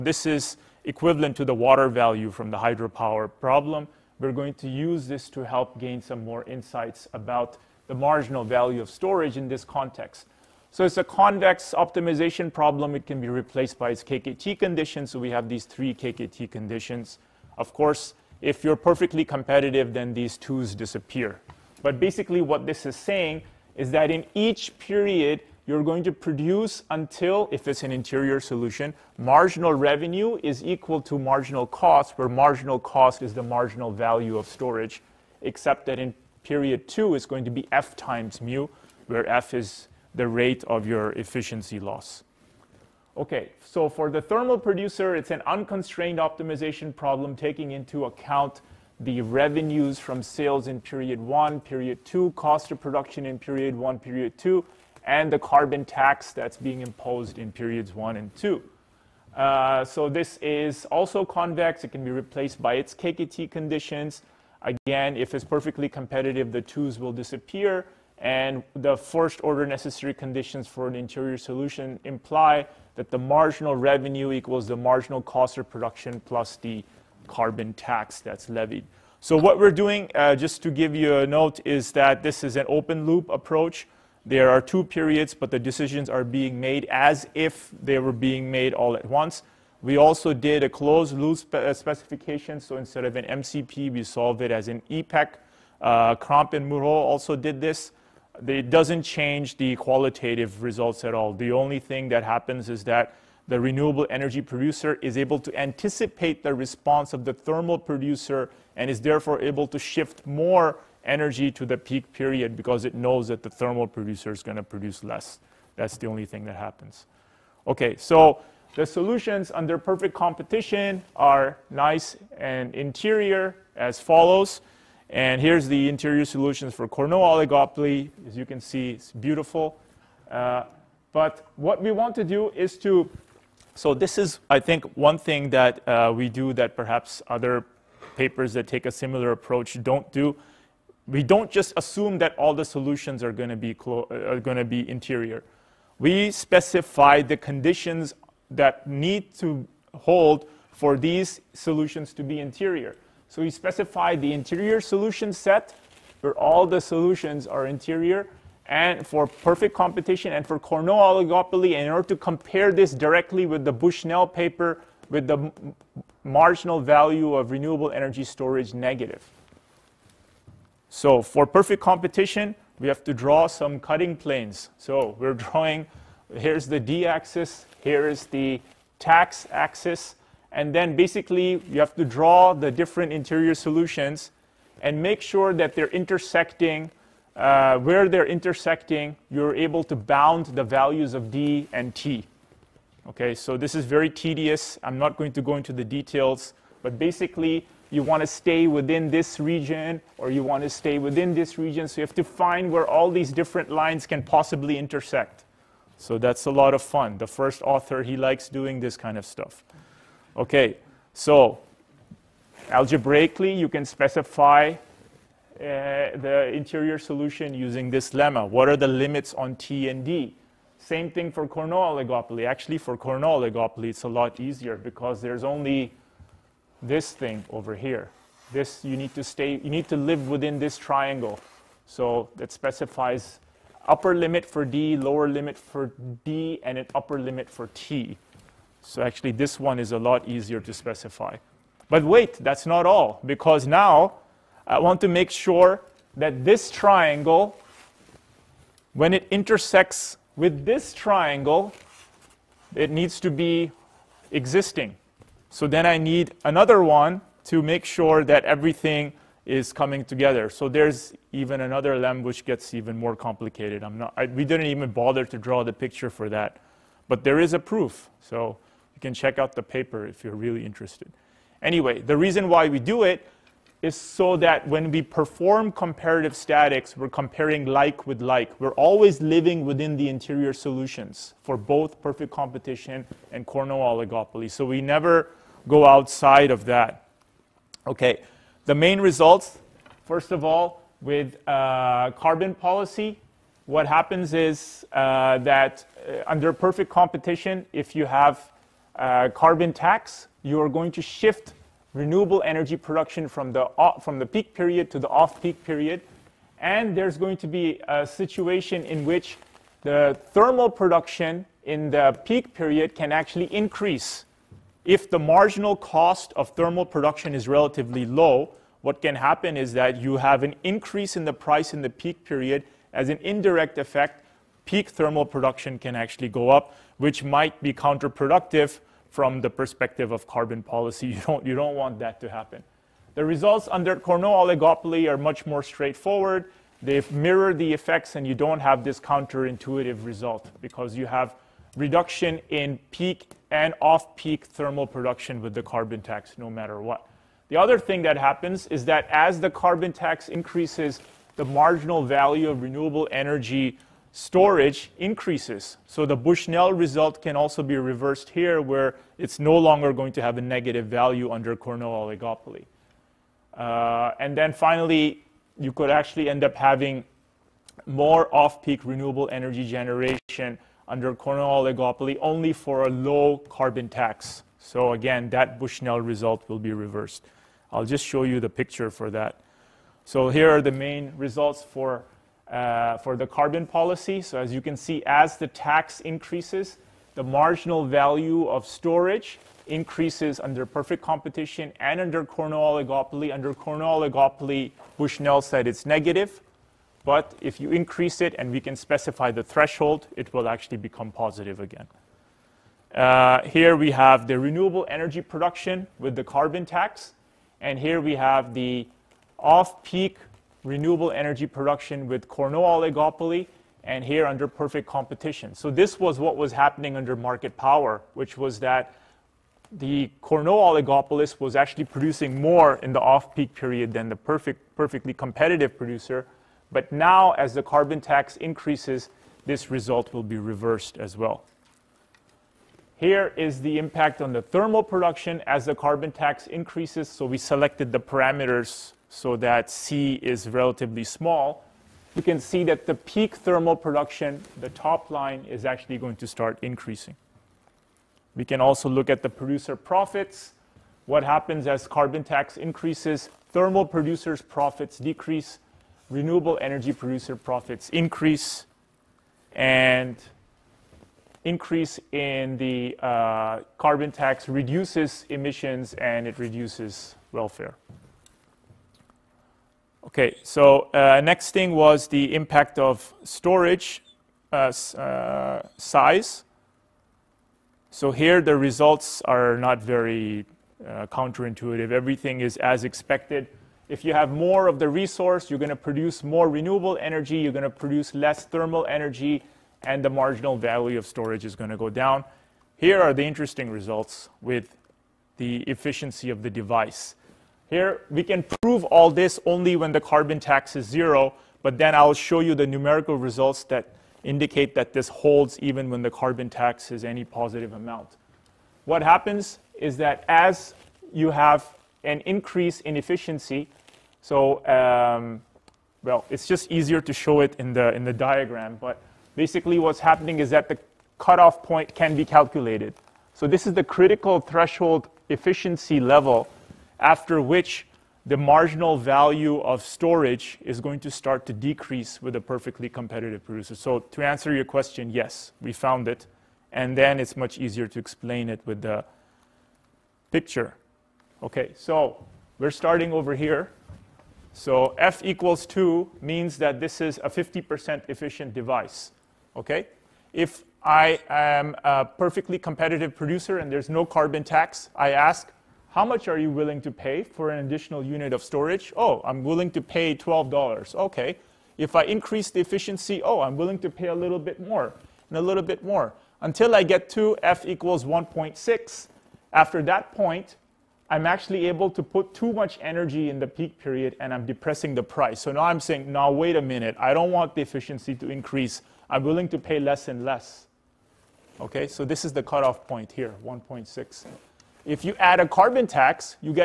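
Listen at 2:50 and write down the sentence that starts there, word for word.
So for perfect competition, we have to draw some cutting planes.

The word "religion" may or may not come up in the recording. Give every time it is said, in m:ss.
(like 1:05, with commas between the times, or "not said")
not said.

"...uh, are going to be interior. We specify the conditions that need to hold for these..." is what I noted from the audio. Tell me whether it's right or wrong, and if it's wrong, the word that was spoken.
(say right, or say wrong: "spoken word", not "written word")
right.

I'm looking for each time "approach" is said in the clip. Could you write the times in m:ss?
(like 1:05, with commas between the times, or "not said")
1:23, 2:19.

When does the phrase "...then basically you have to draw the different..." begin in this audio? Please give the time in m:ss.
3:00.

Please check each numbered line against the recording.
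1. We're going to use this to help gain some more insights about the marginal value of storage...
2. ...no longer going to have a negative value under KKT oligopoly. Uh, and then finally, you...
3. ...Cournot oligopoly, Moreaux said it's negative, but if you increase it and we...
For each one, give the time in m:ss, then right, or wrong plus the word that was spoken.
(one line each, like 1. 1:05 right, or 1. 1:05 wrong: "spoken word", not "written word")
1. 0:04 right
2. 5:59 wrong: "Cournot", not "KKT"
3. 6:33 wrong: "Bushnell", not "Moreaux".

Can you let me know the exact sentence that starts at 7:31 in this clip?
What happens as carbon tax increases?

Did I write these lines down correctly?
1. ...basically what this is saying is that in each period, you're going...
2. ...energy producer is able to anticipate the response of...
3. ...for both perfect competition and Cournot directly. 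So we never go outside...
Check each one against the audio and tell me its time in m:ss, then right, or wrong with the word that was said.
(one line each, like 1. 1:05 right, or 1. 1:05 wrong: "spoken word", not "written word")
1. 0:21 right
2. 1:44 right
3. 4:41 wrong: "oligopoly", not "directly".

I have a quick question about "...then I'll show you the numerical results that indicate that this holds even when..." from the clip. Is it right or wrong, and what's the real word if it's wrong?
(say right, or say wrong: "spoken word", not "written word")
right.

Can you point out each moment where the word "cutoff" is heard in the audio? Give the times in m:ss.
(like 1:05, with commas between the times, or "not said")
8:41, 9:42.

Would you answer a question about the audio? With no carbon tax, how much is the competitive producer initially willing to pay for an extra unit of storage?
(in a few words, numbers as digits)
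$12.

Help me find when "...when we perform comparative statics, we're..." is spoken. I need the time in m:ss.
4:34.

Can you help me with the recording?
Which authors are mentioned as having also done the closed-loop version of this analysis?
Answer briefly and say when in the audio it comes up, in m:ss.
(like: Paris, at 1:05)
Crampes and Moreaux, at 1:36.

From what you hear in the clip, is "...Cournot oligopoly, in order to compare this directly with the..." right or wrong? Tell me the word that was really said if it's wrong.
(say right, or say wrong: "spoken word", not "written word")
right.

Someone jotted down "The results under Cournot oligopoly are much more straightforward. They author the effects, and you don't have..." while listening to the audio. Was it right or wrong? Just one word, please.
wrong.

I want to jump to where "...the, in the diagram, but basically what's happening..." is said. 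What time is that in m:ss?
8:37.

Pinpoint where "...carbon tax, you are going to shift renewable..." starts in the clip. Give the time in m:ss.
4:59.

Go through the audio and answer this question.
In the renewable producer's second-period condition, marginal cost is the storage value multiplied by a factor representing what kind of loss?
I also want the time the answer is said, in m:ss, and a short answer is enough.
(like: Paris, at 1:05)
efficiency loss, at 0:41.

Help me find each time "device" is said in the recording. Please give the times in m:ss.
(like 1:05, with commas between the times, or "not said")
8:16, 9:08.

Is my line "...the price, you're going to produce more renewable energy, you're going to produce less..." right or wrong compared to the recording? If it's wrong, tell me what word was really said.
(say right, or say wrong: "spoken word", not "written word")
wrong: "resource", not "price".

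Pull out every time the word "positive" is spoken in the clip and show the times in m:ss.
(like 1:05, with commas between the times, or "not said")
6:41, 8:27.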